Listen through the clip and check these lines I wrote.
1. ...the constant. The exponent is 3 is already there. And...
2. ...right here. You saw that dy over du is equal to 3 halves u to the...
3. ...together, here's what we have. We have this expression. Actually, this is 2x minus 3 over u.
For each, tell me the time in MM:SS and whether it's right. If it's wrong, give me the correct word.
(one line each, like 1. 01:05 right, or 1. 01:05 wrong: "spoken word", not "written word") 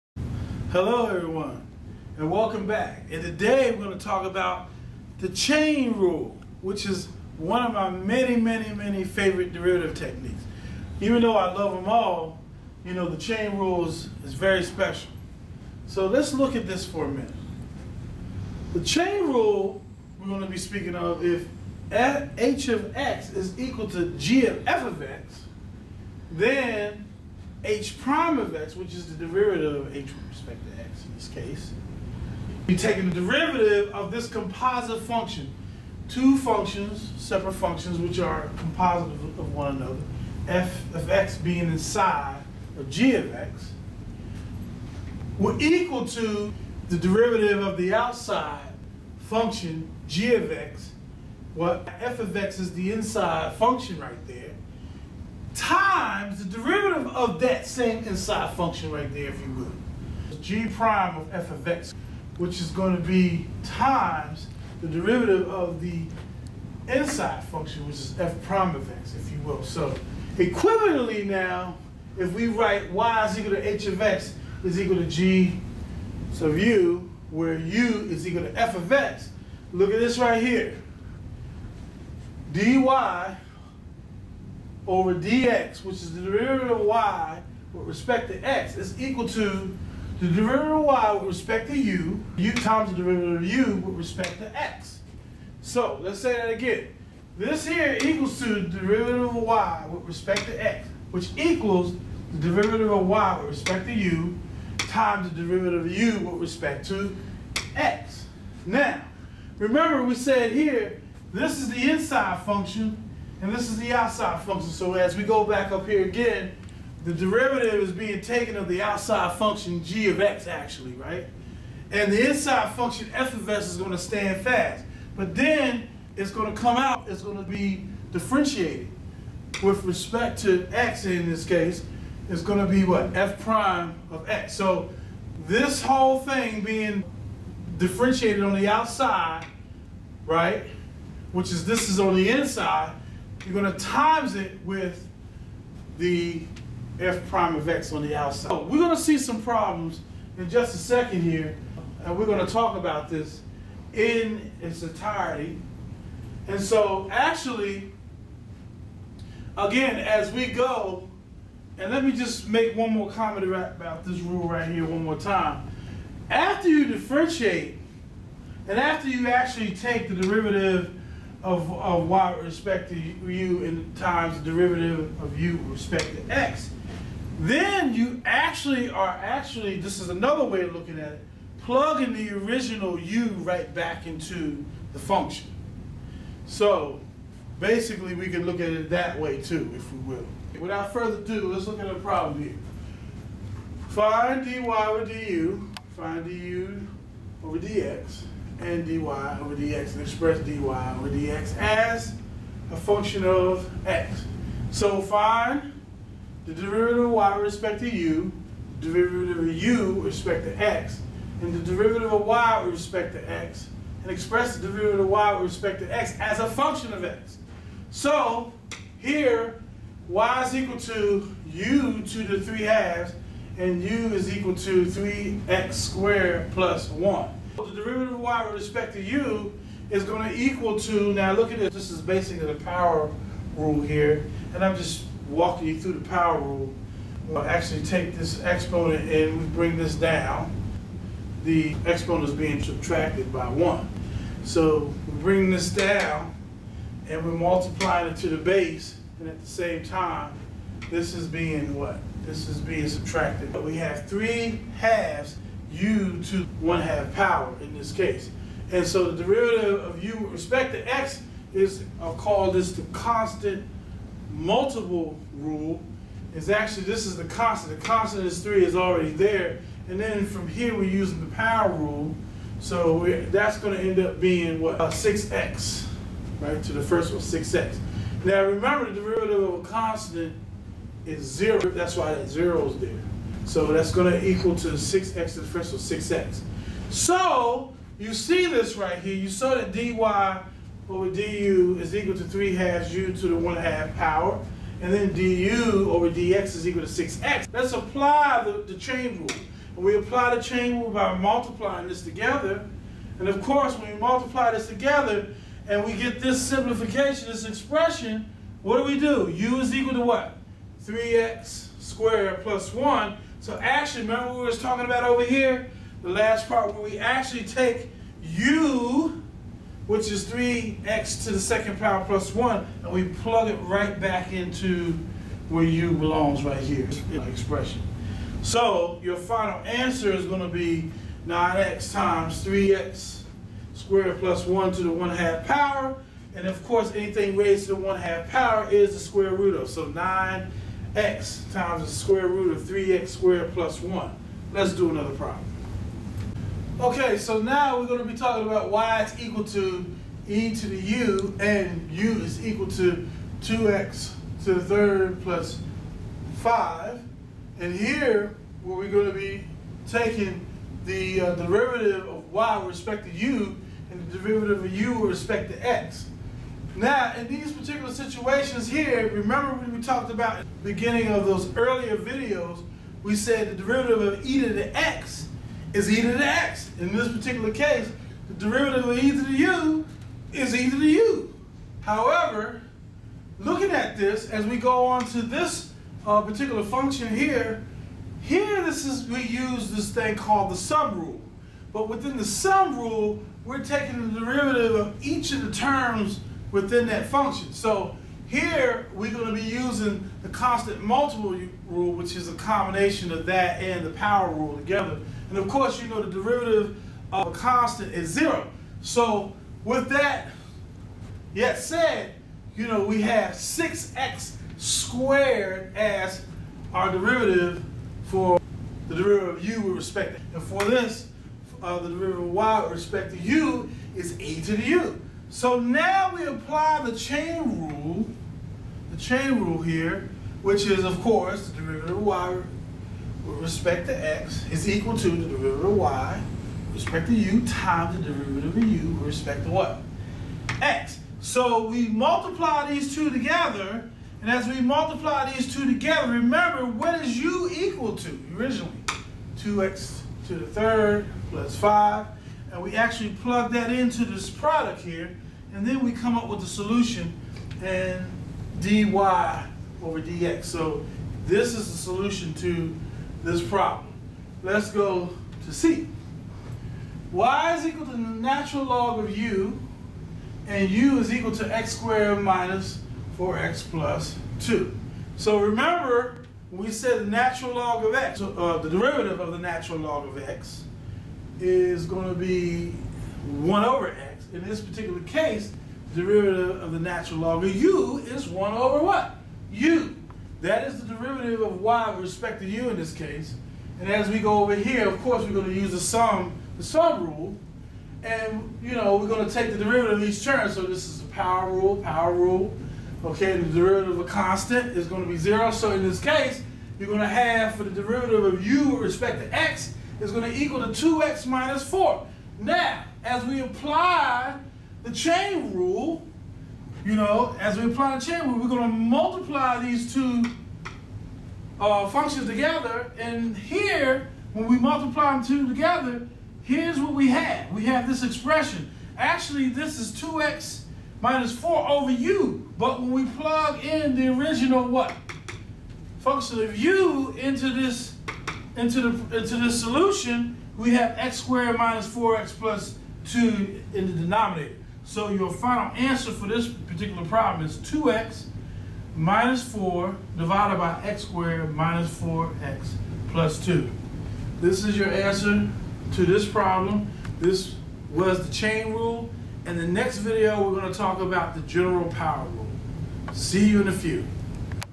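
1. 04:27 wrong: "constant", not "exponent"
2. 04:48 right
3. 08:45 wrong: "4", not "3".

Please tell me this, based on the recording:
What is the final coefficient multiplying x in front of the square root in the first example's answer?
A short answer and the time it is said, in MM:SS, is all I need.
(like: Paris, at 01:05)
9, at 05:39.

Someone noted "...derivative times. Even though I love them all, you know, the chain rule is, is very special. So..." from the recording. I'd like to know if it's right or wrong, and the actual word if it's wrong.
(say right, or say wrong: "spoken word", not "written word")
wrong: "techniques", not "times".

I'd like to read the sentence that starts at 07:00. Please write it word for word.
And for this, uh, the derivative of y with respect to u is e to the u.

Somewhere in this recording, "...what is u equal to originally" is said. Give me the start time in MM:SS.
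07:26.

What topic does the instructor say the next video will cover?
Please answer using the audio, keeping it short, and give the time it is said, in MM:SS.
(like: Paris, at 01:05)
general power rule, at 09:21.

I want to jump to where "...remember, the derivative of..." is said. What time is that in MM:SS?
04:38.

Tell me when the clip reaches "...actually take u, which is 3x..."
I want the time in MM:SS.
05:16.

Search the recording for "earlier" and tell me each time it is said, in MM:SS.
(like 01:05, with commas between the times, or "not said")
06:11.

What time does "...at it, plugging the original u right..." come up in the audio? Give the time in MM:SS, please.
03:00.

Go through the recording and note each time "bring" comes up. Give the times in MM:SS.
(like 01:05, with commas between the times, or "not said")
03:59, 04:05.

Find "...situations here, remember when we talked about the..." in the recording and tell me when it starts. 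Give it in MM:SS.
06:07.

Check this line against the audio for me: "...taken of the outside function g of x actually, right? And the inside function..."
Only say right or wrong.
right.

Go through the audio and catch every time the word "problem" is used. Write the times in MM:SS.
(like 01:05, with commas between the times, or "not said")
02:29, 03:11, 05:45, 07:43, 09:07, 09:16.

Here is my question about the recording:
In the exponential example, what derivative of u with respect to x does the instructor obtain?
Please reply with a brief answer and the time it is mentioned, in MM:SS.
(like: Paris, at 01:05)
6x squared, at 06:53.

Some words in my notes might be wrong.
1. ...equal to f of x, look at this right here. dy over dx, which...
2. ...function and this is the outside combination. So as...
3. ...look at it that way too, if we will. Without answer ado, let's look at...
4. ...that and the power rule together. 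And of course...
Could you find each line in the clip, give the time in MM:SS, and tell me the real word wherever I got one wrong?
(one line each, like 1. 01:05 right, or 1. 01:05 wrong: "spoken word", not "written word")
1. 01:18 right
2. 01:52 wrong: "function", not "combination"
3. 03:08 wrong: "further", not "answer"
4. 06:43 right.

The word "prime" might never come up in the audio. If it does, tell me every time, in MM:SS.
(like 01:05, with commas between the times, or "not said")
00:27, 01:00, 01:08, 02:13, 02:27.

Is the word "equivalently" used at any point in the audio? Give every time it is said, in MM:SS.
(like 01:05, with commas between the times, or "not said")
01:10.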